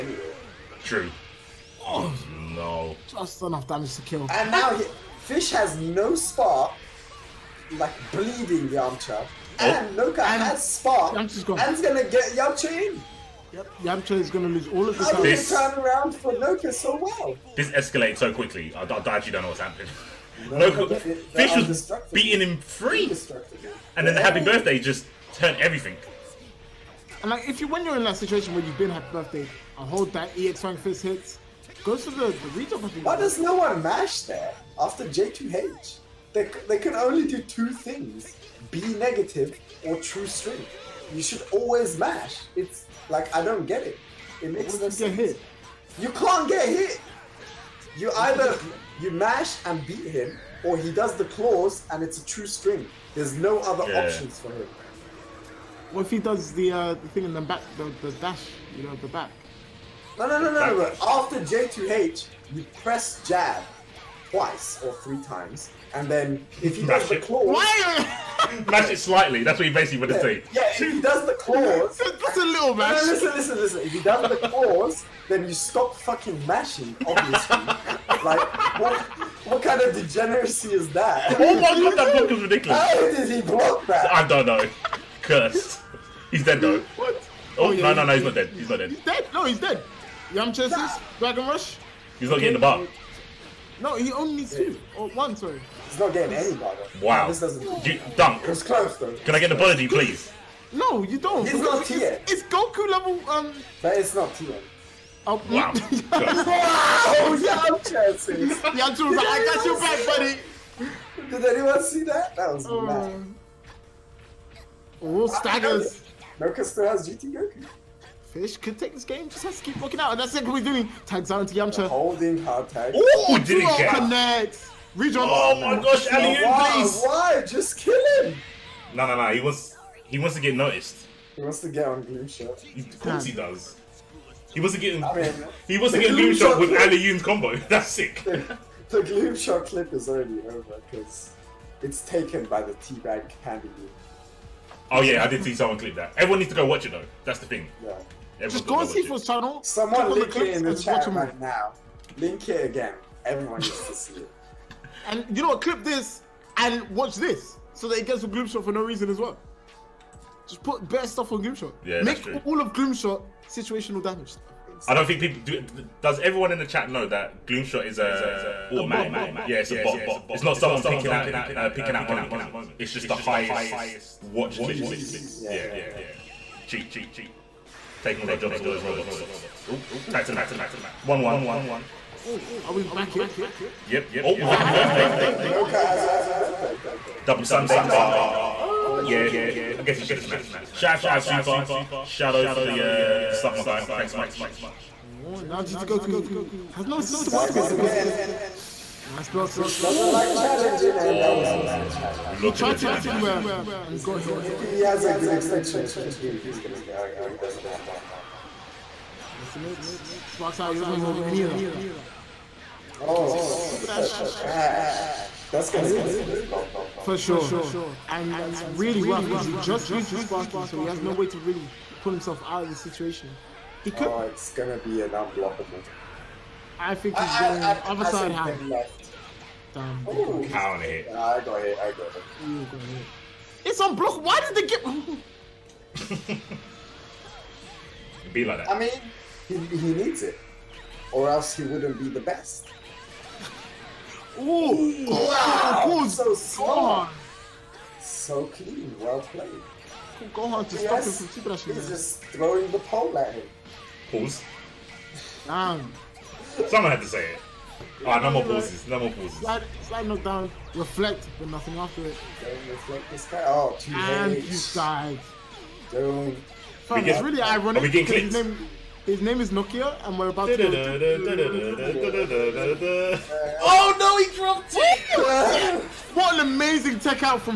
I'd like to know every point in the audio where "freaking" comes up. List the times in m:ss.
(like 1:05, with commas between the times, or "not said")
not said.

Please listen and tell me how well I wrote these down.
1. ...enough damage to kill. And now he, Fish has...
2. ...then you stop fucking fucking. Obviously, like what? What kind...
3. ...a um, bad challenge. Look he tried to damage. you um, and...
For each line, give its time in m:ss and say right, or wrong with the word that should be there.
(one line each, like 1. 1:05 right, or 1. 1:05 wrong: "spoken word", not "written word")
1. 0:03 right
2. 1:15 wrong: "mashing", not "fucking"
3. 3:21 right.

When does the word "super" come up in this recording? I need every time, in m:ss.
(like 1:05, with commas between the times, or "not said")
3:11, 3:33.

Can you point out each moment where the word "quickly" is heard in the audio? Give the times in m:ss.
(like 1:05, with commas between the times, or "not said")
0:18.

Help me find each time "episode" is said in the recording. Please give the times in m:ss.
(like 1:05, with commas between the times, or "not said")
not said.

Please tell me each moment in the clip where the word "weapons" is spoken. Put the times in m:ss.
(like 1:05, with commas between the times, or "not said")
3:17.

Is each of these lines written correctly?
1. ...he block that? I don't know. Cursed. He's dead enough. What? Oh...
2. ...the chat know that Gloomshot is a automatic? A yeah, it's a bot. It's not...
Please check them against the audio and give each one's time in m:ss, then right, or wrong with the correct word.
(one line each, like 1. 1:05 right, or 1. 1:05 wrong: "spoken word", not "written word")
1. 1:23 wrong: "though", not "enough"
2. 2:46 right.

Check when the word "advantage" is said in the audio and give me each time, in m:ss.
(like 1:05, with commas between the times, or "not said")
not said.